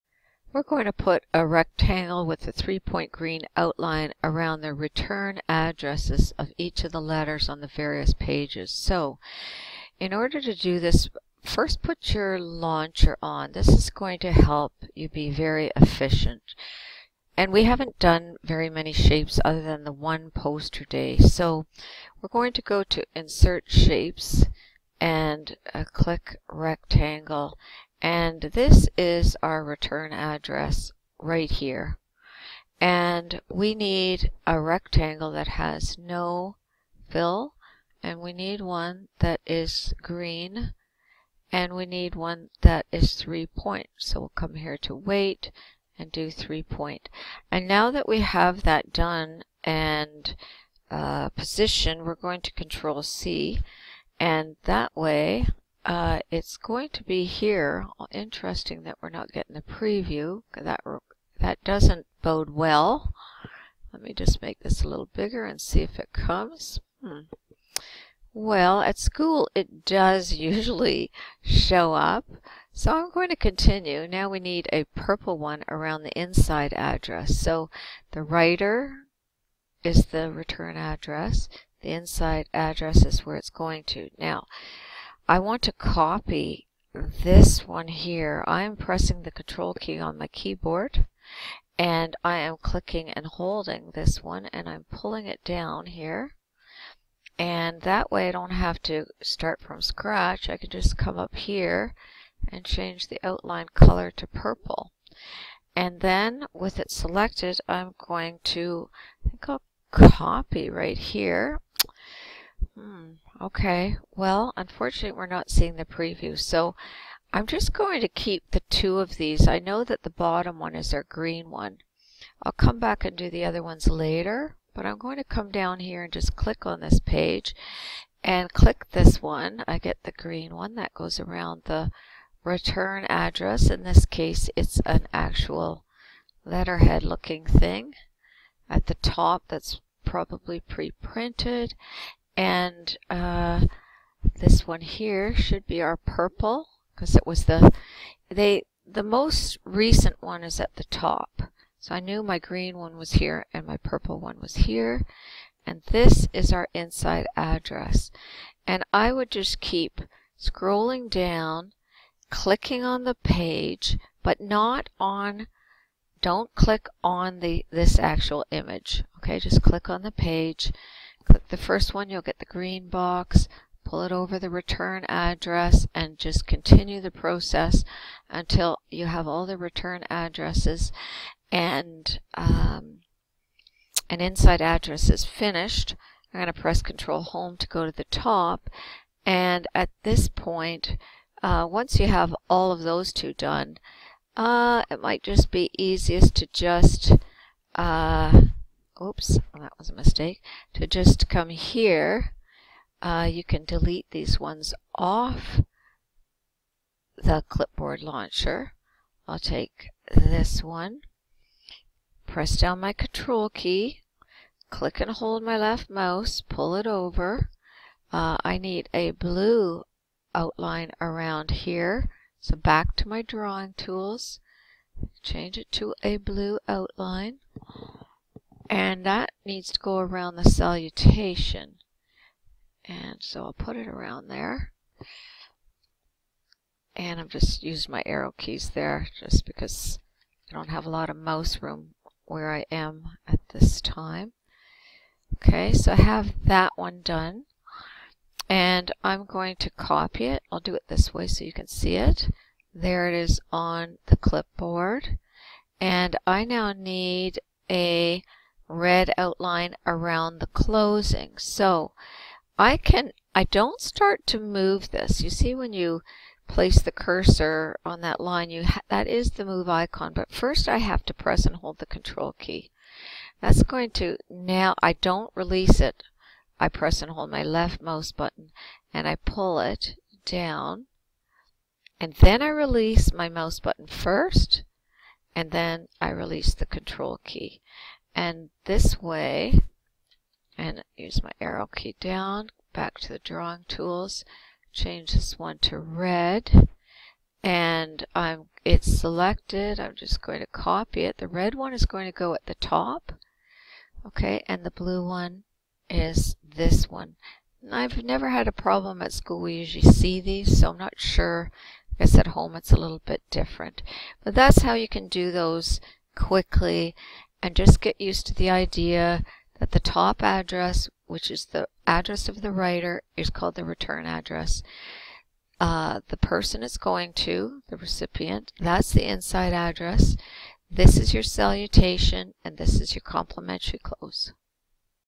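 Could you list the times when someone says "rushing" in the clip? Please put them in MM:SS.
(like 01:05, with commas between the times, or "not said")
not said.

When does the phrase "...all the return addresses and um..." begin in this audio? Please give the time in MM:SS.
02:59.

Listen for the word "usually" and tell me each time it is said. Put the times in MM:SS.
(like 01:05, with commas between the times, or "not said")
01:10, 05:09.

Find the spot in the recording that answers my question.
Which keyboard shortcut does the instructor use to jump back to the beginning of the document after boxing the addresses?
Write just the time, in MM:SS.
03:06.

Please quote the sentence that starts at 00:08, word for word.
So, in order to do this, first put your launcher on.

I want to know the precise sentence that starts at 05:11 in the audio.
I guess at home it's a little bit different.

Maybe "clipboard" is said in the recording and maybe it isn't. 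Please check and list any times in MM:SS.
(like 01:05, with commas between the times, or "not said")
03:27, 04:14.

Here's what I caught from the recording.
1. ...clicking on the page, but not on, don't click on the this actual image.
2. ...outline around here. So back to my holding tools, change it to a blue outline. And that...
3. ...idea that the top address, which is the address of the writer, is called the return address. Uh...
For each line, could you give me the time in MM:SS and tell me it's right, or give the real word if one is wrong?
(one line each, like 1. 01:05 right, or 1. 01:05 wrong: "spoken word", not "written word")
1. 02:42 right
2. 03:40 wrong: "drawing", not "holding"
3. 05:18 right.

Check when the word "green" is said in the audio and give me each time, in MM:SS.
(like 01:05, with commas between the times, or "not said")
00:03, 00:40, 02:01, 02:10, 02:32, 02:52.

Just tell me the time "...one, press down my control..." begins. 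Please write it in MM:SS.
03:30.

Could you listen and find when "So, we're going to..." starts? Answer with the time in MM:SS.
00:21.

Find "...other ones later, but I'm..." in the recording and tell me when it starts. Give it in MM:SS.
02:03.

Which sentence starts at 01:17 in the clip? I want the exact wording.
So the writer is the return address.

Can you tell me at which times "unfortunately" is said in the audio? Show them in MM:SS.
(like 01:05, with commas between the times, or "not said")
01:54.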